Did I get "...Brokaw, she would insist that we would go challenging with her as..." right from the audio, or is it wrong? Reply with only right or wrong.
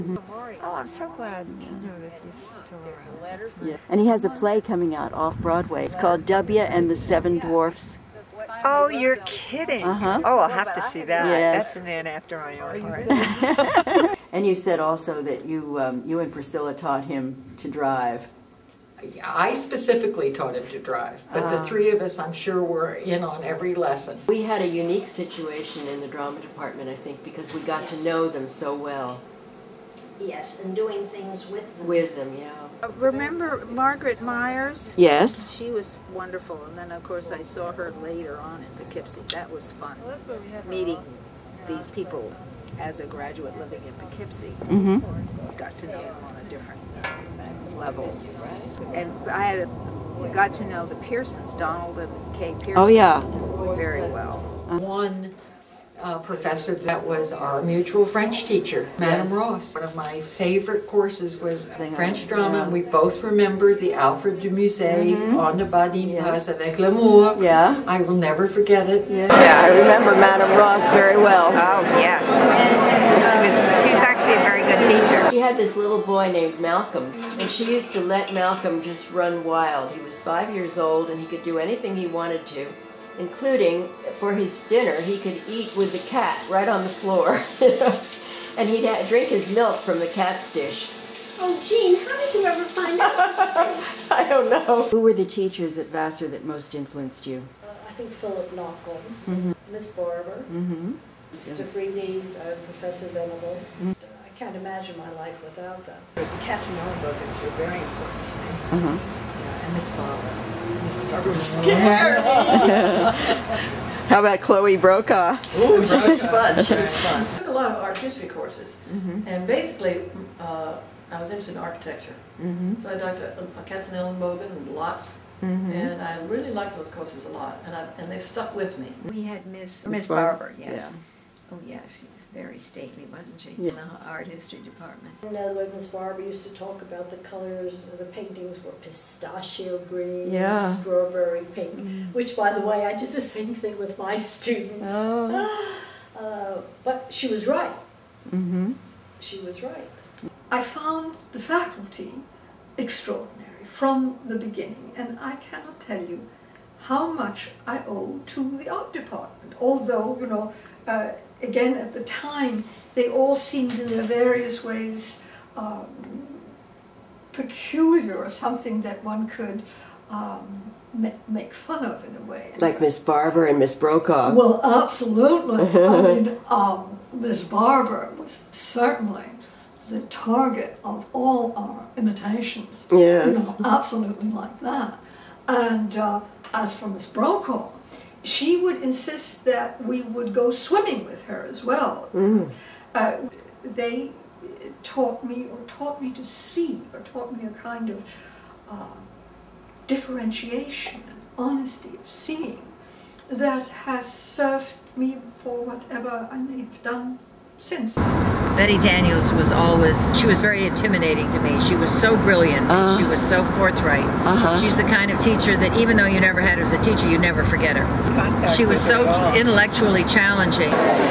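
wrong.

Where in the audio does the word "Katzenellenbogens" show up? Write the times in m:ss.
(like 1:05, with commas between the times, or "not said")
1:46, 2:03.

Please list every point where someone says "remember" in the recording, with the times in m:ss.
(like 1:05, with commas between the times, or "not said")
0:32, 1:03, 1:09.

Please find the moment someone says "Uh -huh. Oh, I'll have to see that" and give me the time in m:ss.
0:09.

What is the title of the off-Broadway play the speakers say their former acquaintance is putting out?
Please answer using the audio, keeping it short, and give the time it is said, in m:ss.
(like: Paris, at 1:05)
W and the Seven Dwarfs, at 0:06.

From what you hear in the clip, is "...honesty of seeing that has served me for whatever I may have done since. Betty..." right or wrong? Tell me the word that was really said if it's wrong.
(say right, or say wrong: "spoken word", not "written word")
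right.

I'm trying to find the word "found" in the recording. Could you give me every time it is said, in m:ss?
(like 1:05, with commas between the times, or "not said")
2:30.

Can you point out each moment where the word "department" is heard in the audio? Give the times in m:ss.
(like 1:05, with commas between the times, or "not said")
0:26, 2:14, 2:38.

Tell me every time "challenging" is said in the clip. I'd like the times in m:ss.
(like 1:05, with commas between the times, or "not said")
3:40.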